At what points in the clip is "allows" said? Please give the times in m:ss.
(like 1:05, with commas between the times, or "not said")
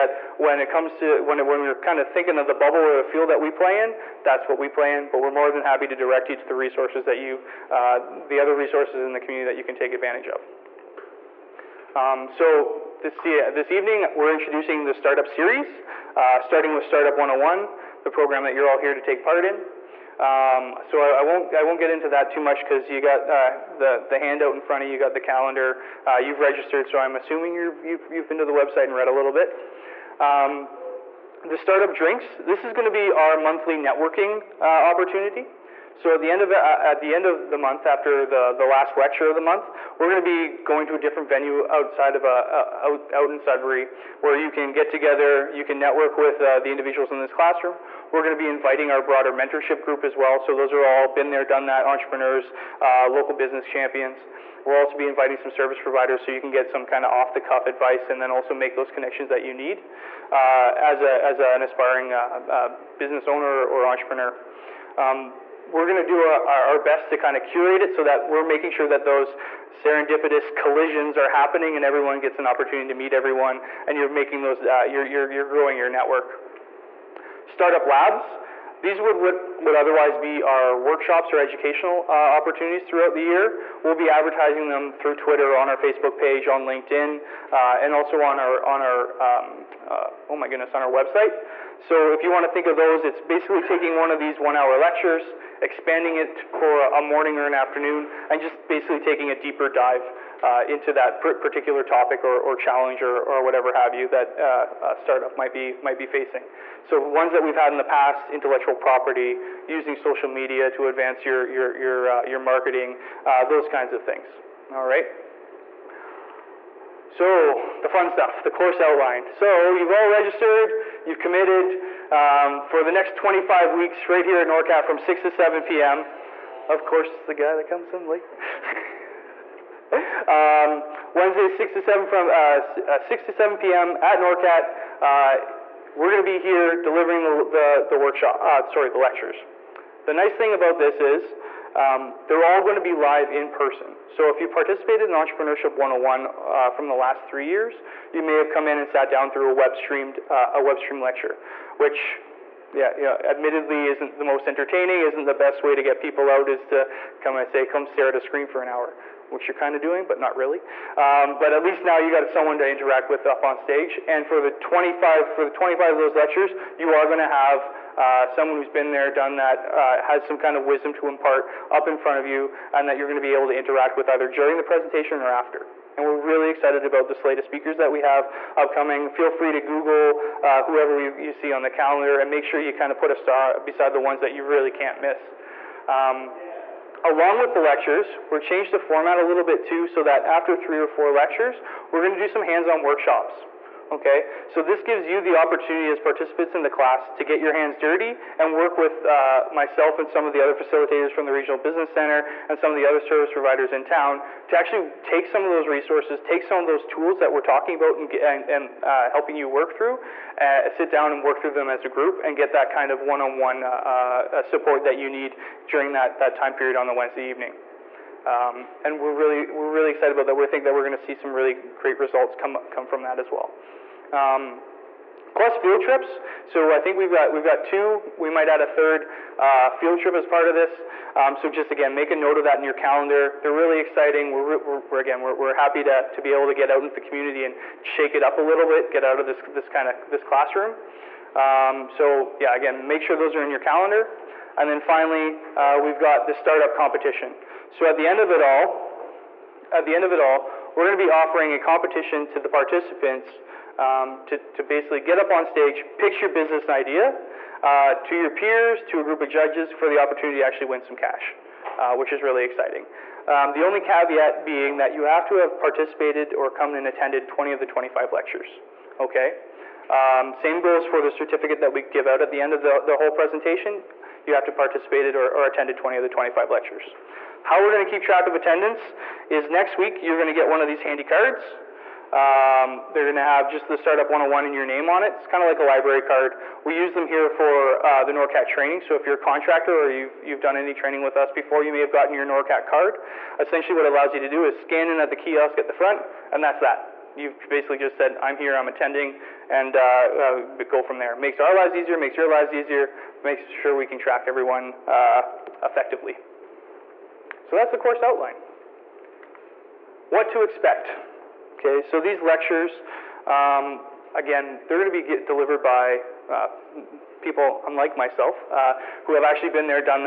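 4:53.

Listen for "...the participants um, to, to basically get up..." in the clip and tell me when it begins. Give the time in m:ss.
4:12.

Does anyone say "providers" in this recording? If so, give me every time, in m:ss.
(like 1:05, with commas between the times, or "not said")
0:55, 3:23.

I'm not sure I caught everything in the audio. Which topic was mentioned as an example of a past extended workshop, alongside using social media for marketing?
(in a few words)
Intellectual property.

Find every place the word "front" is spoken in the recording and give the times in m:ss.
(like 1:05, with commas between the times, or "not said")
0:24, 2:51, 4:55.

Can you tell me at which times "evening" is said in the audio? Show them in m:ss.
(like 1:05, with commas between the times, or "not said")
0:13, 3:37.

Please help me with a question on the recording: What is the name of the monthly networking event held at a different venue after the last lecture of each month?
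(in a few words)
Startup Drinks.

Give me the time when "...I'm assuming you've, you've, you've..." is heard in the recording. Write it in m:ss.
0:26.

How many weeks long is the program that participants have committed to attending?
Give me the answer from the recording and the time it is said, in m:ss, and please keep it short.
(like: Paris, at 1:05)
25, at 2:03.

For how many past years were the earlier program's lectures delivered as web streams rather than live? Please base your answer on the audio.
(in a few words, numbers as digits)
3.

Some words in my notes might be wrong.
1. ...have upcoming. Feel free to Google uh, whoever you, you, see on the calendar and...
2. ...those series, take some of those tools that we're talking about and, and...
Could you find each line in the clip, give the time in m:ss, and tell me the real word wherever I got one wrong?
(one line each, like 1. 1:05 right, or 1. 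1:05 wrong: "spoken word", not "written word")
1. 2:58 right
2. 3:25 wrong: "resources", not "series".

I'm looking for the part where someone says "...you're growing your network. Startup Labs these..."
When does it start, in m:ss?
1:15.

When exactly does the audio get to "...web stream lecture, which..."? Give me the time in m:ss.
2:30.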